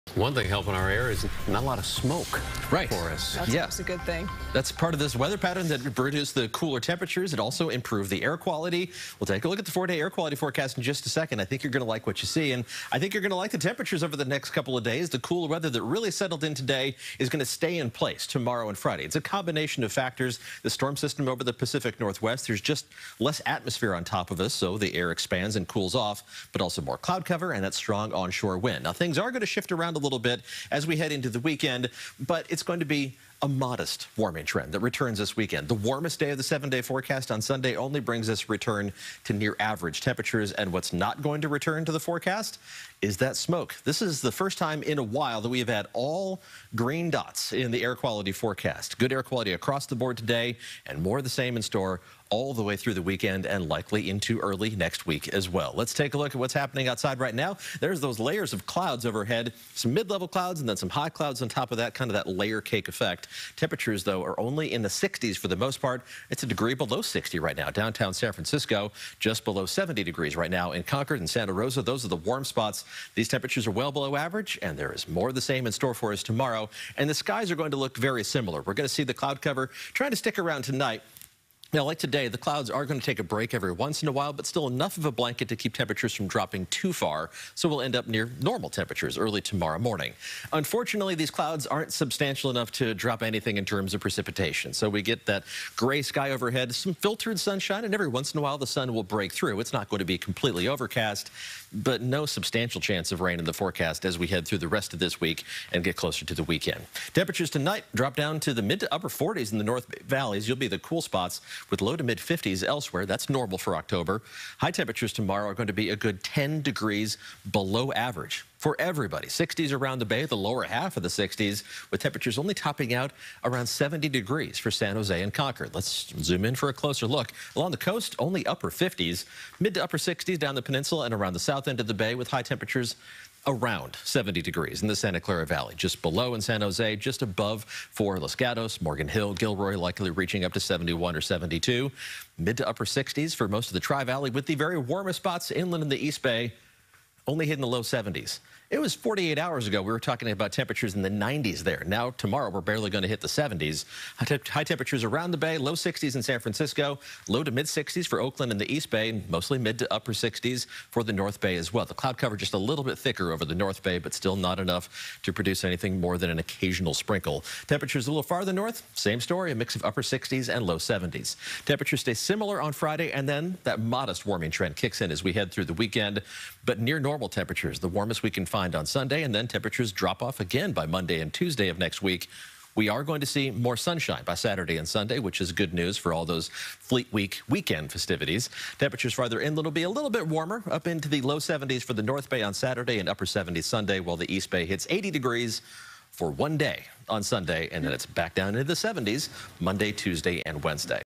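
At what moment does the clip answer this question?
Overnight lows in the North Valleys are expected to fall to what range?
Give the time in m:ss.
1:48.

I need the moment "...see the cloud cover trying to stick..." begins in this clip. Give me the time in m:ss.
1:18.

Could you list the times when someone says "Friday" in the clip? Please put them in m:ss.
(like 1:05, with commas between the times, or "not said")
0:18, 2:52.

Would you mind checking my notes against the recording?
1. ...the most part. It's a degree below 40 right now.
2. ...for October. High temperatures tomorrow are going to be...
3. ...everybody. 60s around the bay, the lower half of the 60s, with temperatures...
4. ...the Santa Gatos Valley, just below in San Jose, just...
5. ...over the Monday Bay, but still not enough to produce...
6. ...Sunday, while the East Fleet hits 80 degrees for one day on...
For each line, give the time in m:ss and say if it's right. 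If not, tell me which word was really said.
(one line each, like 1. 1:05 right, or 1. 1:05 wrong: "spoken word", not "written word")
1. 1:05 wrong: "60", not "40"
2. 1:53 right
3. 1:58 right
4. 2:14 wrong: "Clara", not "Gatos"
5. 2:43 wrong: "North", not "Monday"
6. 3:13 wrong: "Bay", not "Fleet".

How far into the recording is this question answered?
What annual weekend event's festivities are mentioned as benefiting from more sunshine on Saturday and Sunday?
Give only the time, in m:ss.
3:06.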